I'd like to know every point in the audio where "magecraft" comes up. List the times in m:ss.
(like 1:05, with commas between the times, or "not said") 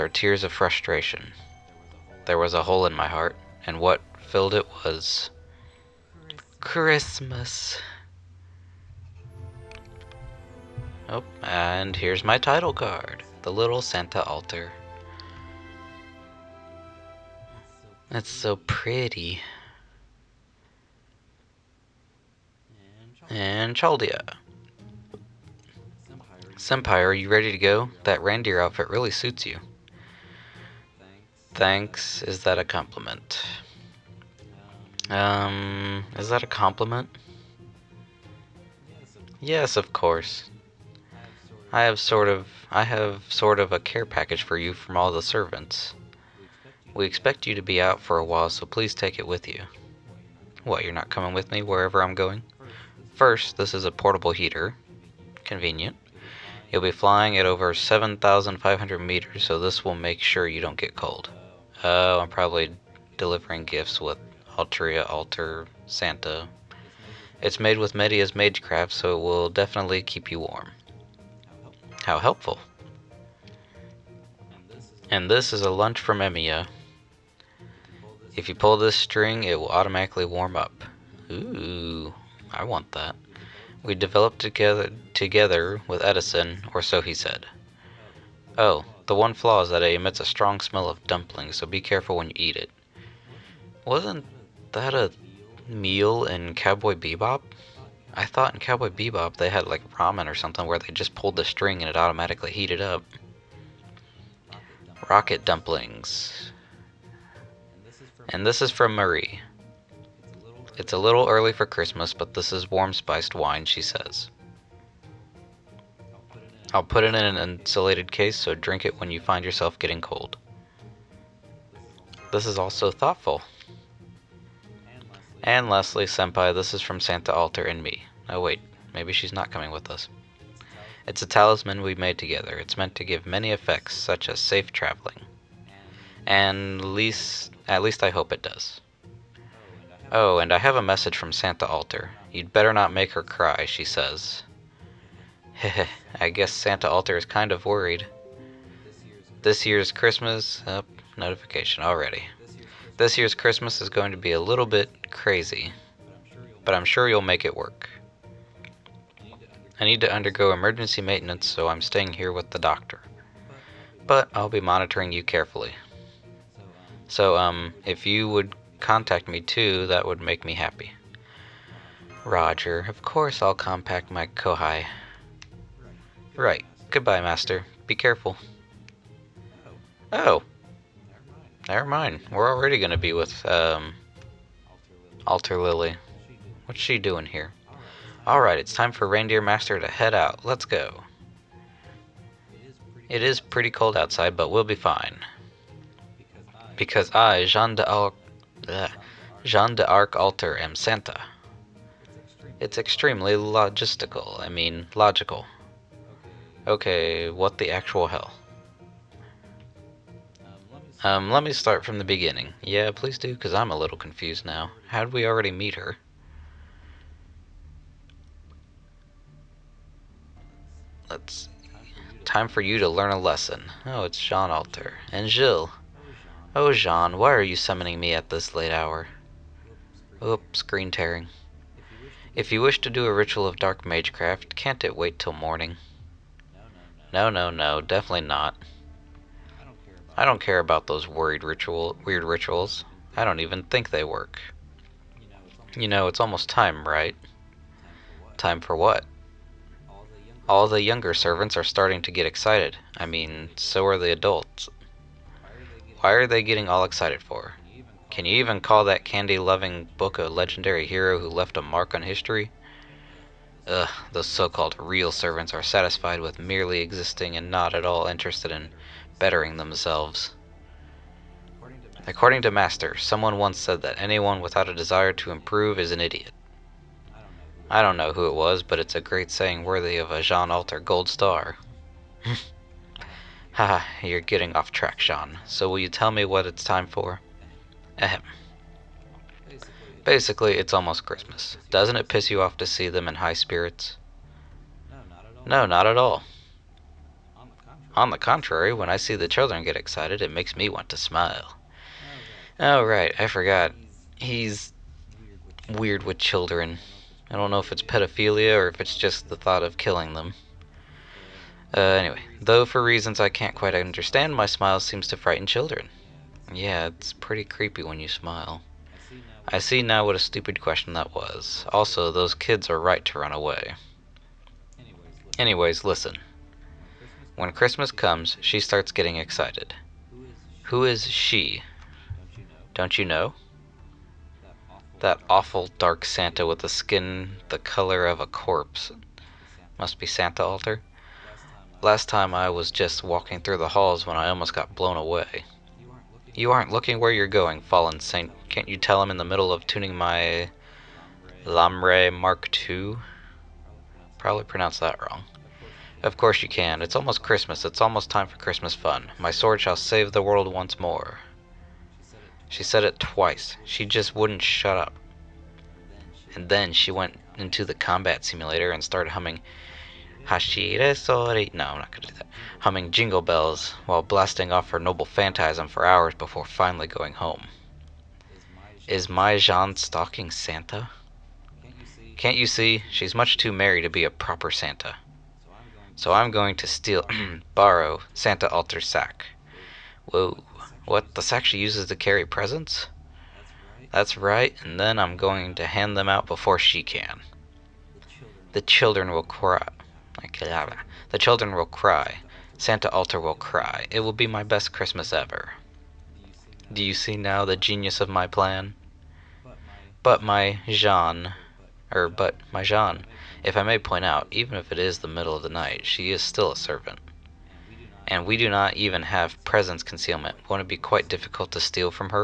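1:08, 3:53.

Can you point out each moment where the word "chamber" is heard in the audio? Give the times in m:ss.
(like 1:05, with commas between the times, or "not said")
not said.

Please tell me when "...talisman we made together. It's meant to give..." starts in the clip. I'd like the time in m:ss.
2:11.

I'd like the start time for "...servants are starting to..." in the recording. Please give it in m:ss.
4:11.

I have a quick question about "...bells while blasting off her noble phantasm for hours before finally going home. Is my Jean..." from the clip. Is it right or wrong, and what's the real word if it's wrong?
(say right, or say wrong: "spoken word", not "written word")
right.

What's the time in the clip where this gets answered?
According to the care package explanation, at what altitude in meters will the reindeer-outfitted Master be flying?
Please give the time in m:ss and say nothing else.
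0:57.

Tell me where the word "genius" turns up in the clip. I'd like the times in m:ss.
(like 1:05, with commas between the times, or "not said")
6:47.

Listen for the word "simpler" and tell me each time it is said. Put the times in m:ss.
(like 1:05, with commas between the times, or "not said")
not said.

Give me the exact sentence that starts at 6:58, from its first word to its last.
And we do not even have presence concealment.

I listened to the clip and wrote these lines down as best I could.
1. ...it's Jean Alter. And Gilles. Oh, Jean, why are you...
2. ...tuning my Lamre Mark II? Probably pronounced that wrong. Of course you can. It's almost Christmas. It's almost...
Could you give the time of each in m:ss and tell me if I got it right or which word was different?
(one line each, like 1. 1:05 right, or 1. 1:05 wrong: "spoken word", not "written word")
1. 3:44 right
2. 5:49 right.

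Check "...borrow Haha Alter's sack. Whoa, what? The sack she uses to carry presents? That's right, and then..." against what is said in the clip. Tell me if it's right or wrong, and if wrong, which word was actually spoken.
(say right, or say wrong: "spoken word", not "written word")
wrong: "Santa", not "Haha".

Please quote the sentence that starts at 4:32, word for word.
According to Master, someone once said that anyone without a desire to improve is an idiot.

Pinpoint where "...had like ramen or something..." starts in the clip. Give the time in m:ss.
1:39.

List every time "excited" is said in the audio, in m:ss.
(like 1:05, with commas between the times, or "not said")
4:12, 4:16, 4:59, 5:29.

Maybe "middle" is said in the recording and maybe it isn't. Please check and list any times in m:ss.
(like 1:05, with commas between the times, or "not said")
5:49, 6:55.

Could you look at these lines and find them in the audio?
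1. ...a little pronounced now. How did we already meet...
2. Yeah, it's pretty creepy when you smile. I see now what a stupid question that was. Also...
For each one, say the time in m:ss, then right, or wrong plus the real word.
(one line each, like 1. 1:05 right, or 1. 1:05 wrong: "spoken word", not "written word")
1. 3:33 wrong: "confused", not "pronounced"
2. 5:16 right.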